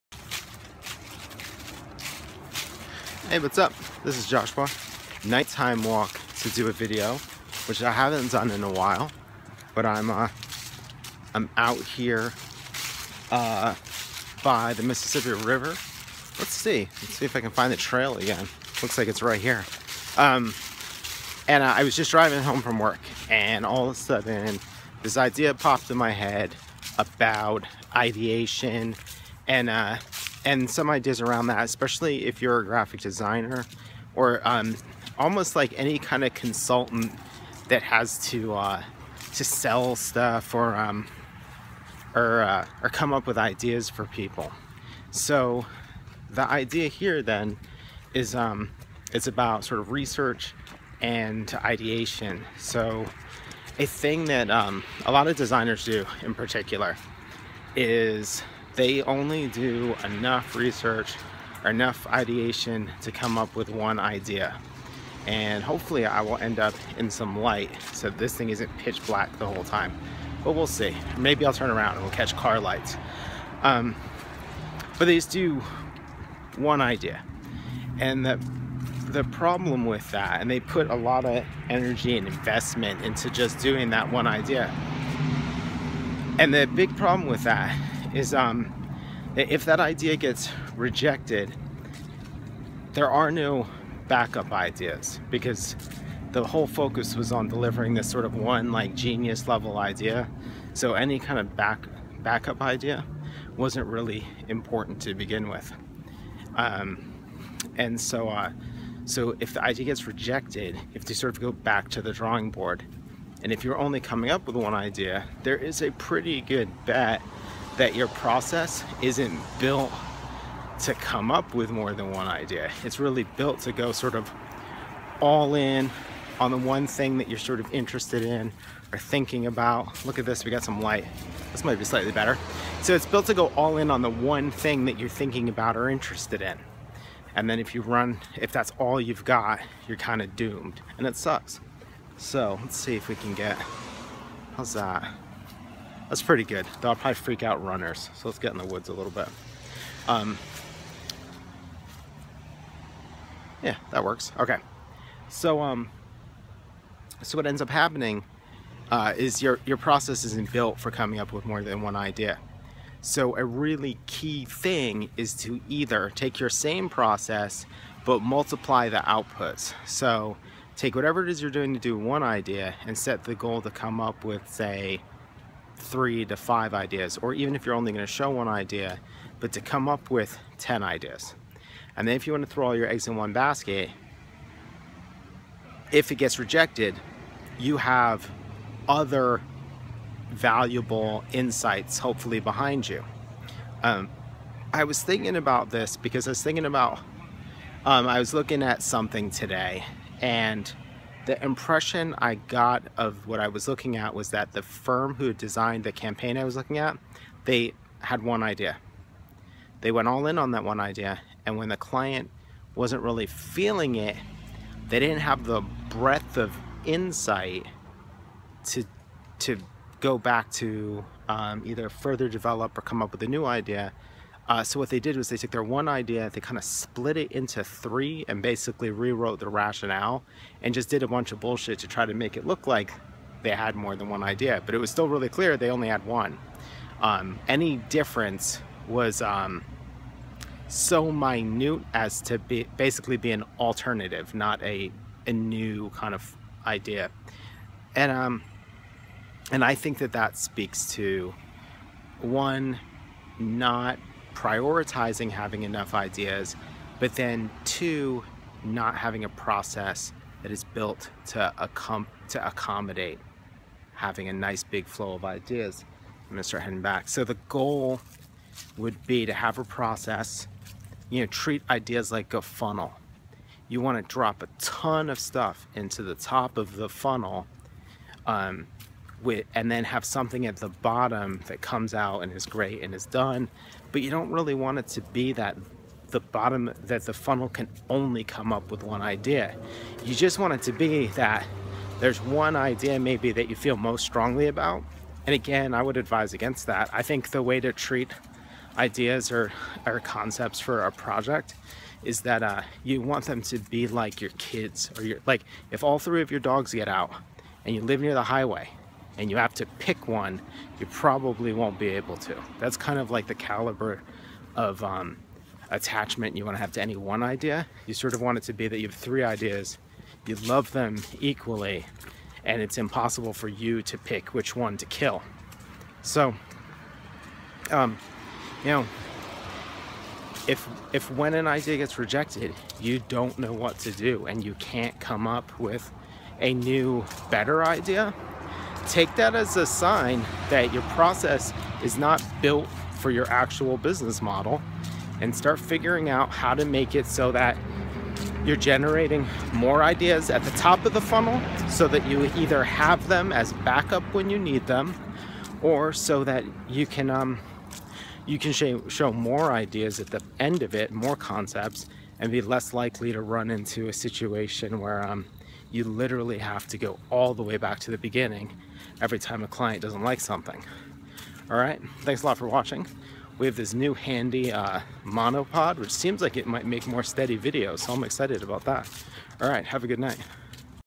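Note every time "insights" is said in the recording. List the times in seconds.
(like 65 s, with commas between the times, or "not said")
191 s, 216 s.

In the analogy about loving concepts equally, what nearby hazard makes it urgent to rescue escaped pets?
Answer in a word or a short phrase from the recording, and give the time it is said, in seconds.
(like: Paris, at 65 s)
The highway, at 308 s.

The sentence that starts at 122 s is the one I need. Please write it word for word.
It's really built to go sort of all in on the one thing that you're sort of interested in or thinking about.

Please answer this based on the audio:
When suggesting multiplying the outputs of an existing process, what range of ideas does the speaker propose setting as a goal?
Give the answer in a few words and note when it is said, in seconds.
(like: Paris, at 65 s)
3 to 5, at 175 s.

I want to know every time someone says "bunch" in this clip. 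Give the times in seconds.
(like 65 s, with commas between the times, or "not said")
231 s.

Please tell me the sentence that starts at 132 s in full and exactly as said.
So it's built to go all in on the one thing that you're thinking about or interested in.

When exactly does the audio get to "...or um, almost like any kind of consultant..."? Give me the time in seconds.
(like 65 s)
34 s.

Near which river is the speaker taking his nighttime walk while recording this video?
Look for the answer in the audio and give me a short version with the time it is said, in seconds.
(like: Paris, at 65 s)
Mississippi River, at 14 s.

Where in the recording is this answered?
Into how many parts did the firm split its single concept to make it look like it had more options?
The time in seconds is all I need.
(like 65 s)
226 s.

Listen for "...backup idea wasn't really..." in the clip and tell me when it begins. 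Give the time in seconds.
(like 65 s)
102 s.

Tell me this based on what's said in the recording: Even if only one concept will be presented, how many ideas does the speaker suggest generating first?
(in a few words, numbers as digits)
10.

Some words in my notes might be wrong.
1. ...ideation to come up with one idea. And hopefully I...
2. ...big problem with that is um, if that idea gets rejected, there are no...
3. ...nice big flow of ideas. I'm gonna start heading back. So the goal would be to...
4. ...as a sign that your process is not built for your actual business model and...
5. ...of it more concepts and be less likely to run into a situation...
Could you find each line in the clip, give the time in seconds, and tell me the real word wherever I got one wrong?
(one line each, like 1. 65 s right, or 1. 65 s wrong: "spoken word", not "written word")
1. 62 s right
2. 86 s right
3. 264 s right
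4. 339 s right
5. 360 s right.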